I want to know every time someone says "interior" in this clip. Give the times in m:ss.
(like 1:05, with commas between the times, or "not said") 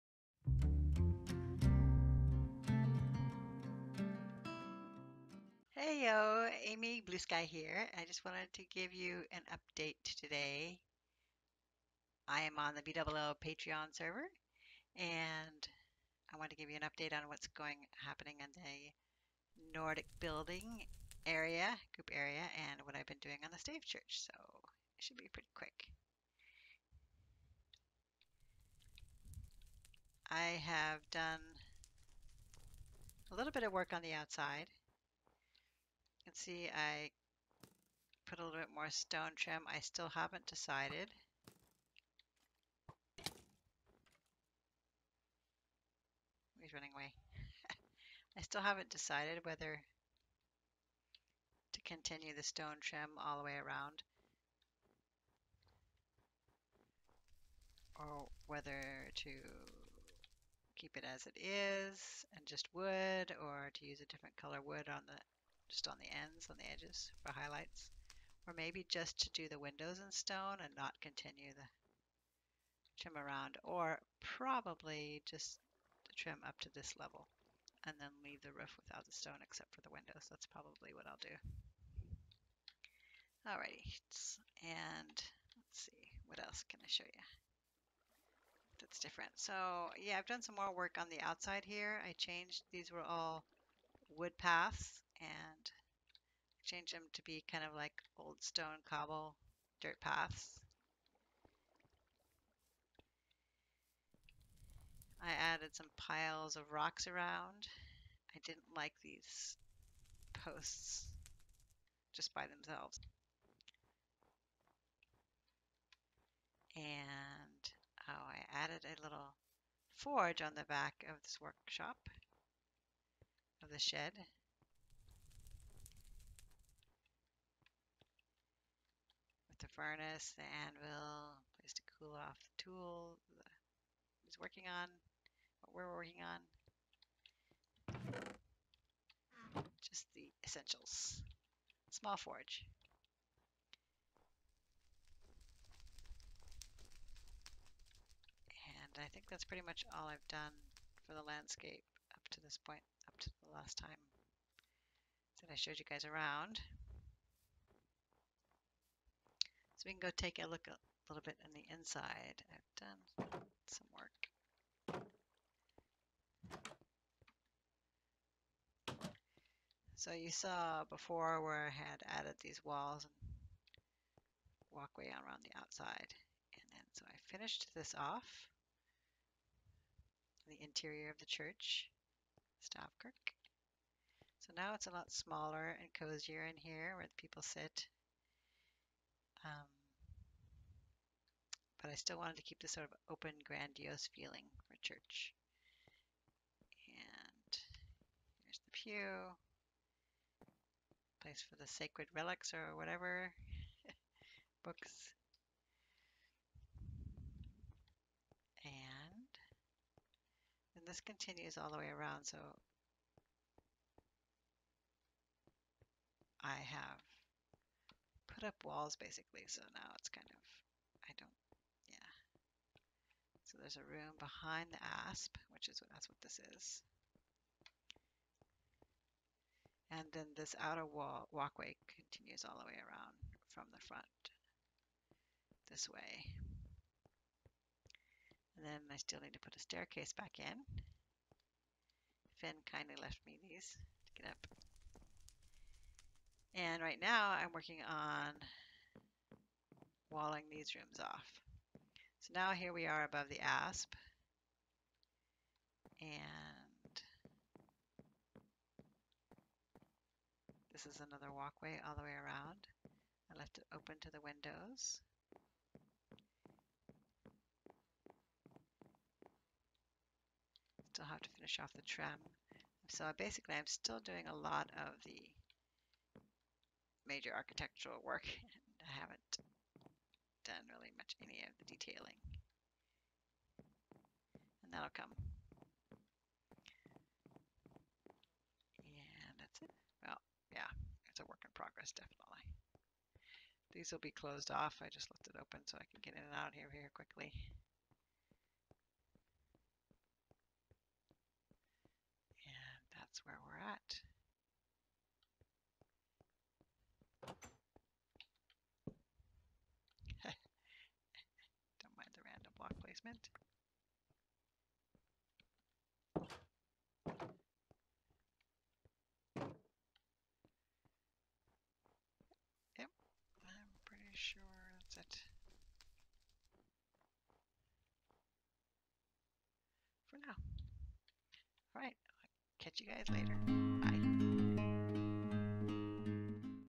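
3:00.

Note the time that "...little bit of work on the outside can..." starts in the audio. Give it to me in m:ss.
0:33.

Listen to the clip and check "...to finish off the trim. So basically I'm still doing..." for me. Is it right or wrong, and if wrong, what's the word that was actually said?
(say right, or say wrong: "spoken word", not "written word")
right.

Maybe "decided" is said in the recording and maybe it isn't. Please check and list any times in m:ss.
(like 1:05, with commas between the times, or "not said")
0:40, 0:48.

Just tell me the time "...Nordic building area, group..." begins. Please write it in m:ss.
0:19.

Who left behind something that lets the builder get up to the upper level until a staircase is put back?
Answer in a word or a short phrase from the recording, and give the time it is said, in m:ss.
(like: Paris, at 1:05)
Finn, at 4:02.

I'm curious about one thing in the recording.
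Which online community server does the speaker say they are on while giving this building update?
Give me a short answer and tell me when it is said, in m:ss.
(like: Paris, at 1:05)
BWO Patreon, at 0:12.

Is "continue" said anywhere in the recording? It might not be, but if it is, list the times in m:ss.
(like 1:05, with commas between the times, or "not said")
0:51, 1:10, 3:31, 3:51.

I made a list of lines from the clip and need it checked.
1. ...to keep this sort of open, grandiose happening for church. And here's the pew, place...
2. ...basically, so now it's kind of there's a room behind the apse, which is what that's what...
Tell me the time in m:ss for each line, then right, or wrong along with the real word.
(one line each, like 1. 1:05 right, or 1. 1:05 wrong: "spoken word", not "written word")
1. 3:12 wrong: "feeling", not "happening"
2. 3:38 right.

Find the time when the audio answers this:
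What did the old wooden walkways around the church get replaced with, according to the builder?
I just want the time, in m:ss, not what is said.
1:38.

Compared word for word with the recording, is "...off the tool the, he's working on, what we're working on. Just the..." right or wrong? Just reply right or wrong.
right.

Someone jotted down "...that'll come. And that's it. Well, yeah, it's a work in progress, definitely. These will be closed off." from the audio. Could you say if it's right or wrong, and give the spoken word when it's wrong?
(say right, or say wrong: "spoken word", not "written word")
right.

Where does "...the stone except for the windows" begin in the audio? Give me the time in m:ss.
1:19.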